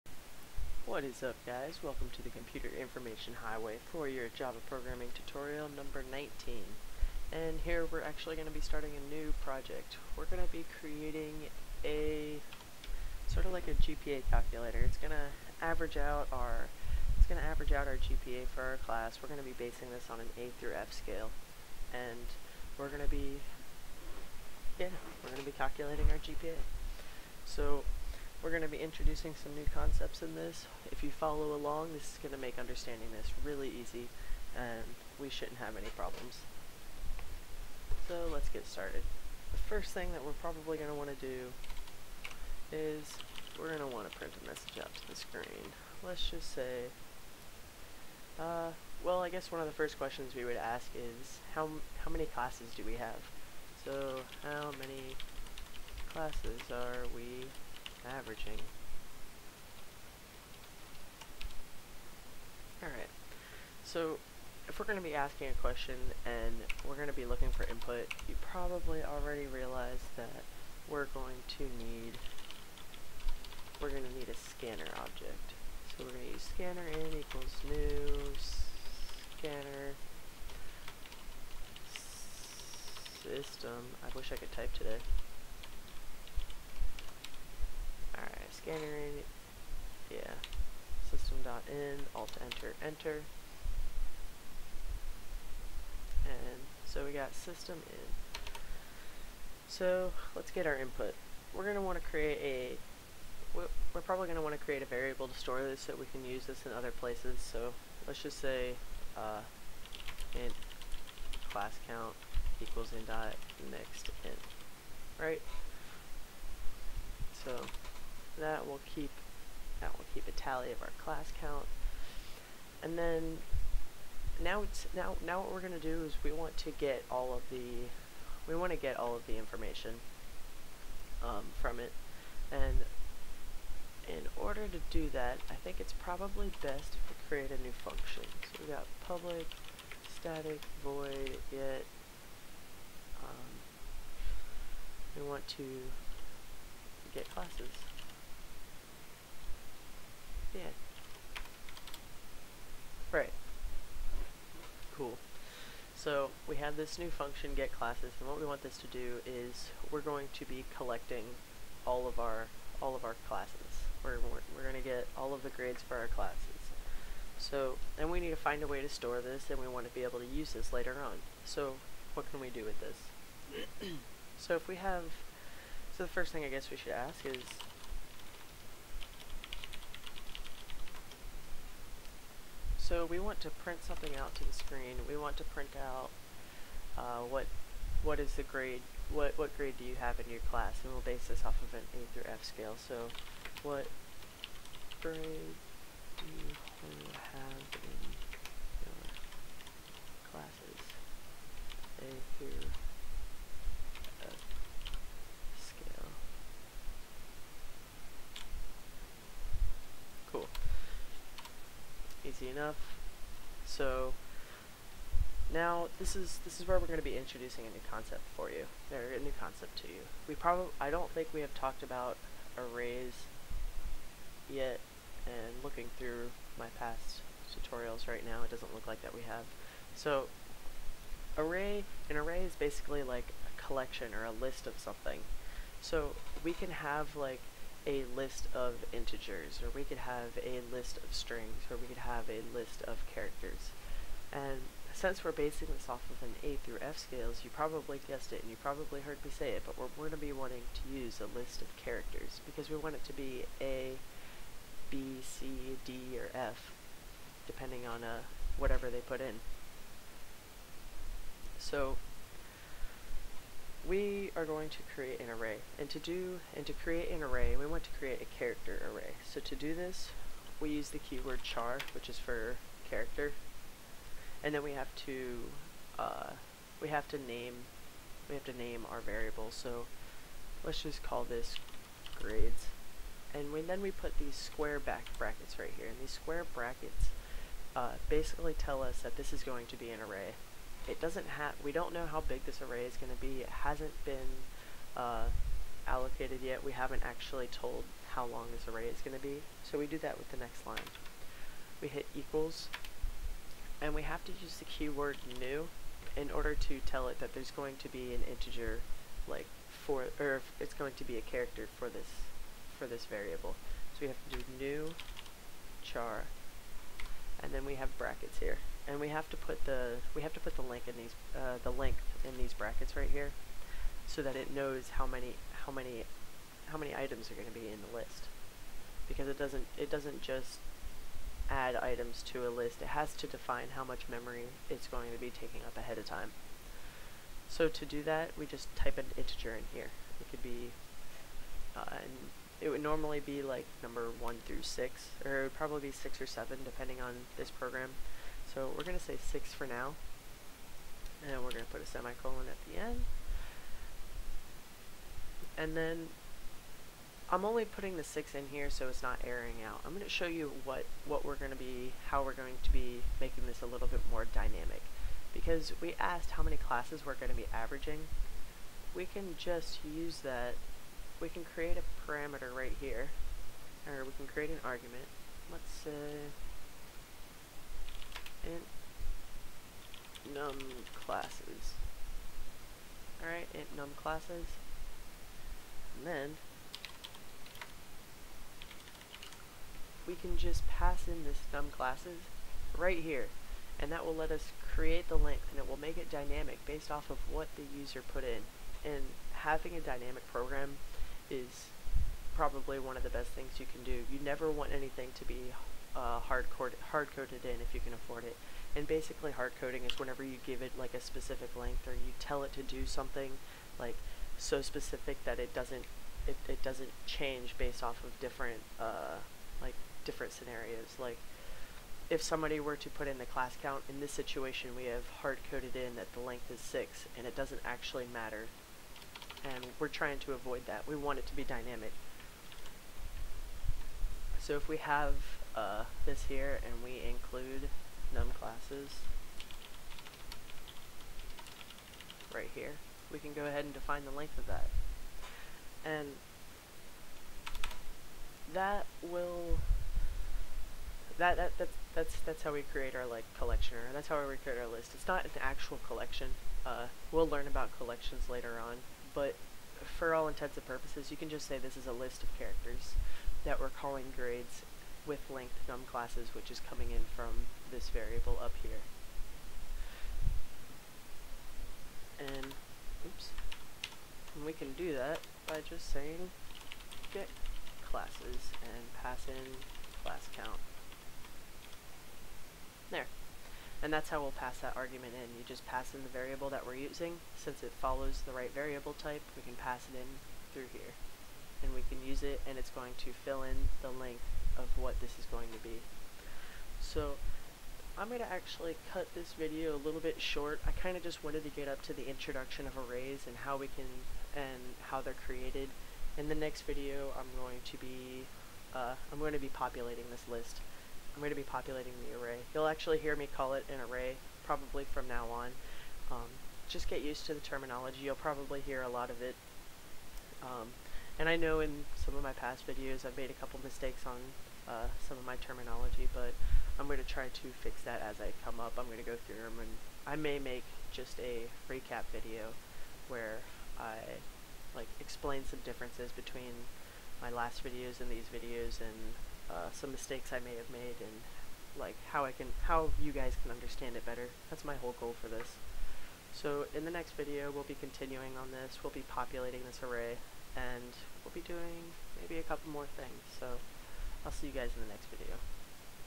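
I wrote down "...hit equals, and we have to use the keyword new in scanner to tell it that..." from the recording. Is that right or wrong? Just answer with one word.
wrong.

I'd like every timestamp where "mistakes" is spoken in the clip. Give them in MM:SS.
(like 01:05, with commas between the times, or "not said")
08:43, 08:59.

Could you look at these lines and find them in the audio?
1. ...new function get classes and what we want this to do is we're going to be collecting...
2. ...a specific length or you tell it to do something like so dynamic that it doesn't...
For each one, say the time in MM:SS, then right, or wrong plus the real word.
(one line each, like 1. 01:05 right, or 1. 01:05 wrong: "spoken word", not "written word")
1. 02:36 right
2. 06:50 wrong: "specific", not "dynamic".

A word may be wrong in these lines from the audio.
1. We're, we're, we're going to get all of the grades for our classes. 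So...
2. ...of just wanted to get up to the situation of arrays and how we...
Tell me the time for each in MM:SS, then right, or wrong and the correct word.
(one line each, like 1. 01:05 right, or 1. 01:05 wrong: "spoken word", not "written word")
1. 02:44 right
2. 08:20 wrong: "introduction", not "situation".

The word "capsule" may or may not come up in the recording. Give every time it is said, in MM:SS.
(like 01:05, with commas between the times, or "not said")
not said.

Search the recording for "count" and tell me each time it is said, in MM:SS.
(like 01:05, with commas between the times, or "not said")
01:51, 02:01, 07:03, 08:00.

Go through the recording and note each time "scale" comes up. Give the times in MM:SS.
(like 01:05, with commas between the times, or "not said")
00:20, 03:12, 04:06.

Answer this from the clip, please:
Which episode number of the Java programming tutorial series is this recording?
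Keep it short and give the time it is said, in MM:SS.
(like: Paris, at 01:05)
19, at 00:05.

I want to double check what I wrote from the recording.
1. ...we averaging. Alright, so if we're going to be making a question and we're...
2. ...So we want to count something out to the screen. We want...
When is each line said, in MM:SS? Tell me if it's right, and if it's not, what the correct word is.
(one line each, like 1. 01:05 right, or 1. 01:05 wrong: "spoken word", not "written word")
1. 00:57 wrong: "asking", not "making"
2. 03:02 wrong: "print", not "count".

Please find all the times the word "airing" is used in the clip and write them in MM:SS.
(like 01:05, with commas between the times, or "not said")
05:59.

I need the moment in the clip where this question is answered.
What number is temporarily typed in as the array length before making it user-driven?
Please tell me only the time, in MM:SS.
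05:48.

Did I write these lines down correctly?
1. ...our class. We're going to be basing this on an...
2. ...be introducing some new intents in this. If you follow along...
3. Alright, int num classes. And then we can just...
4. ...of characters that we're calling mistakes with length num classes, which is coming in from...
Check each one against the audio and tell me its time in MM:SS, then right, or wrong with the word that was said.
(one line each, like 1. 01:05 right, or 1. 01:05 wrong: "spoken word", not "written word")
1. 00:18 right
2. 00:28 wrong: "concepts", not "intents"
3. 06:23 right
4. 07:42 wrong: "grades", not "mistakes".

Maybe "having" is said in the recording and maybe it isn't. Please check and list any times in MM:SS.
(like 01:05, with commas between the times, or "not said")
06:39.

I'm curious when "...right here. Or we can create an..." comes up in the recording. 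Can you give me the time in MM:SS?
06:12.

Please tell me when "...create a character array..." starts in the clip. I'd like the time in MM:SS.
04:27.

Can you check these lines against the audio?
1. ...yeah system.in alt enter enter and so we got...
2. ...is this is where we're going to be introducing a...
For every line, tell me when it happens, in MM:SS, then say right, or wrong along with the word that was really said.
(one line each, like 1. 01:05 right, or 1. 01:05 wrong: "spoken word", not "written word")
1. 01:30 right
2. 03:36 right.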